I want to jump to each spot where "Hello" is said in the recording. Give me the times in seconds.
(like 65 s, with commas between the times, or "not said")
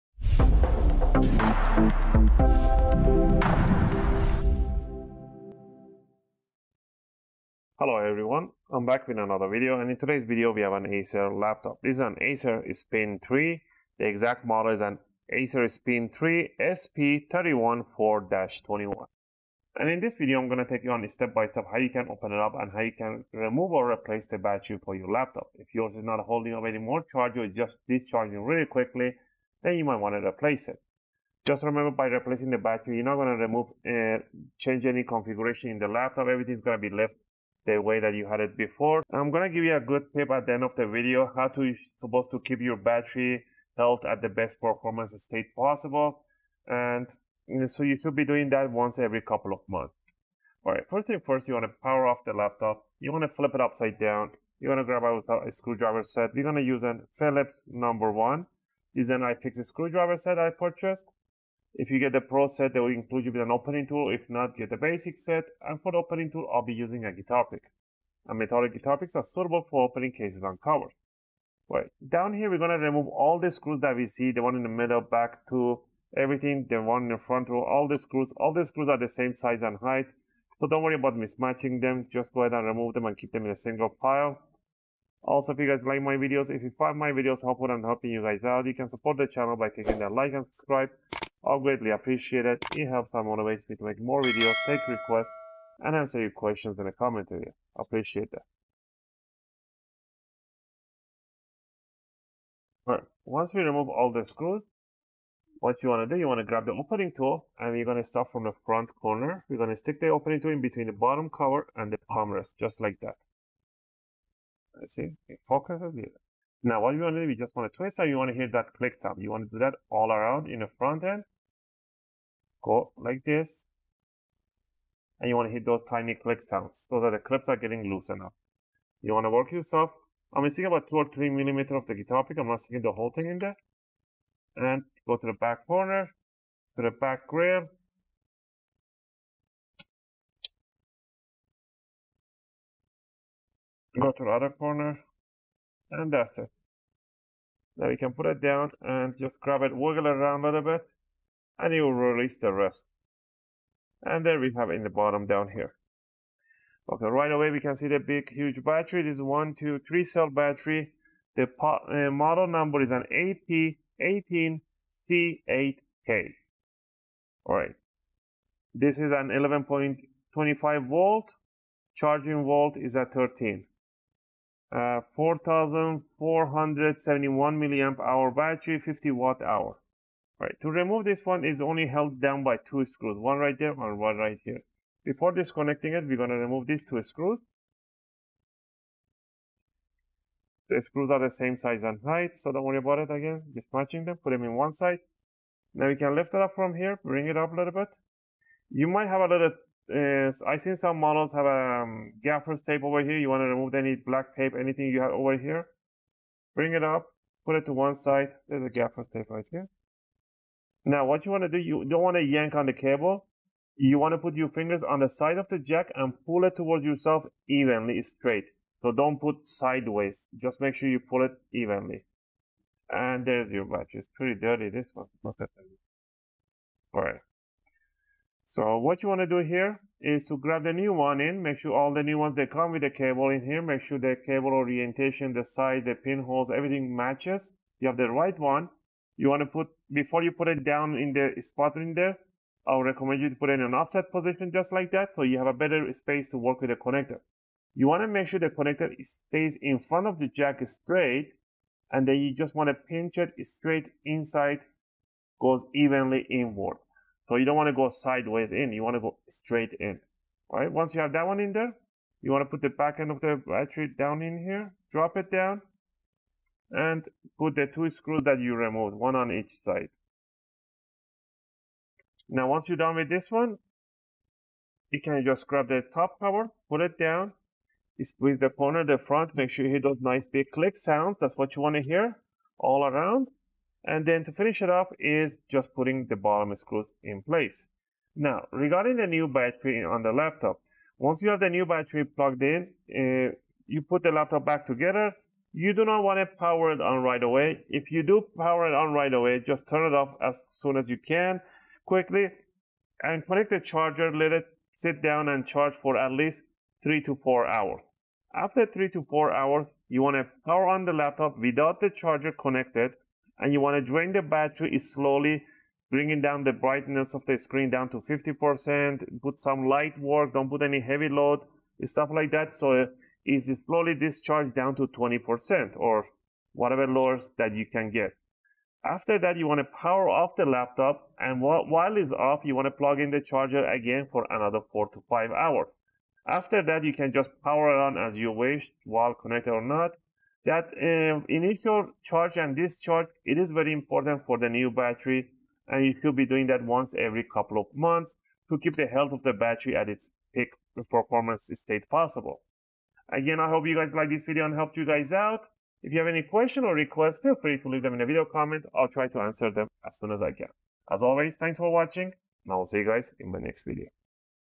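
7 s.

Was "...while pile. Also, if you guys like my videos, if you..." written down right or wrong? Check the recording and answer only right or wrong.
wrong.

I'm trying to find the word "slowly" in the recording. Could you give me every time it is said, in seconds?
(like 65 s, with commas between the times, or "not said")
314 s, 323 s.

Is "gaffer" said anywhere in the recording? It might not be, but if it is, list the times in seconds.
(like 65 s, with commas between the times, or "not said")
202 s, 208 s.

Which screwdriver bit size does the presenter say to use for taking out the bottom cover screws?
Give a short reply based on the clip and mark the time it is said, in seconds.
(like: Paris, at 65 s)
Phillips number one, at 57 s.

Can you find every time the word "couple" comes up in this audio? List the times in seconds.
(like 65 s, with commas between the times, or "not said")
49 s, 347 s.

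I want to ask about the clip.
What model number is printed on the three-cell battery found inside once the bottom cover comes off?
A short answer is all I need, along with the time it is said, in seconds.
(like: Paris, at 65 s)
AP18C8K, at 163 s.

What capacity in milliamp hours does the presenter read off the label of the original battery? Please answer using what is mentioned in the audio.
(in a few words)
4,471 mAh.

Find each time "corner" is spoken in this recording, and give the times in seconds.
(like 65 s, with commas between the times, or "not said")
108 s, 135 s, 144 s, 278 s.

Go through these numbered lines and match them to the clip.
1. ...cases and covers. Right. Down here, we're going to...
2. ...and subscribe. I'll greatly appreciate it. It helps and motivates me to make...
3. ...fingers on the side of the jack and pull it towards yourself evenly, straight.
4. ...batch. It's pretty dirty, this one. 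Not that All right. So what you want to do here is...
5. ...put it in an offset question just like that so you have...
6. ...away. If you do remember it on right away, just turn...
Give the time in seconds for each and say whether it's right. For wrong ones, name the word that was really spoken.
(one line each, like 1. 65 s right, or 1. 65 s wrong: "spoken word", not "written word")
1. 70 s right
2. 90 s right
3. 214 s right
4. 223 s right
5. 243 s wrong: "position", not "question"
6. 297 s wrong: "power", not "remember".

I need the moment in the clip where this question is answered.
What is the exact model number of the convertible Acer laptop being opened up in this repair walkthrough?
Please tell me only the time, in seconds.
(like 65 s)
16 s.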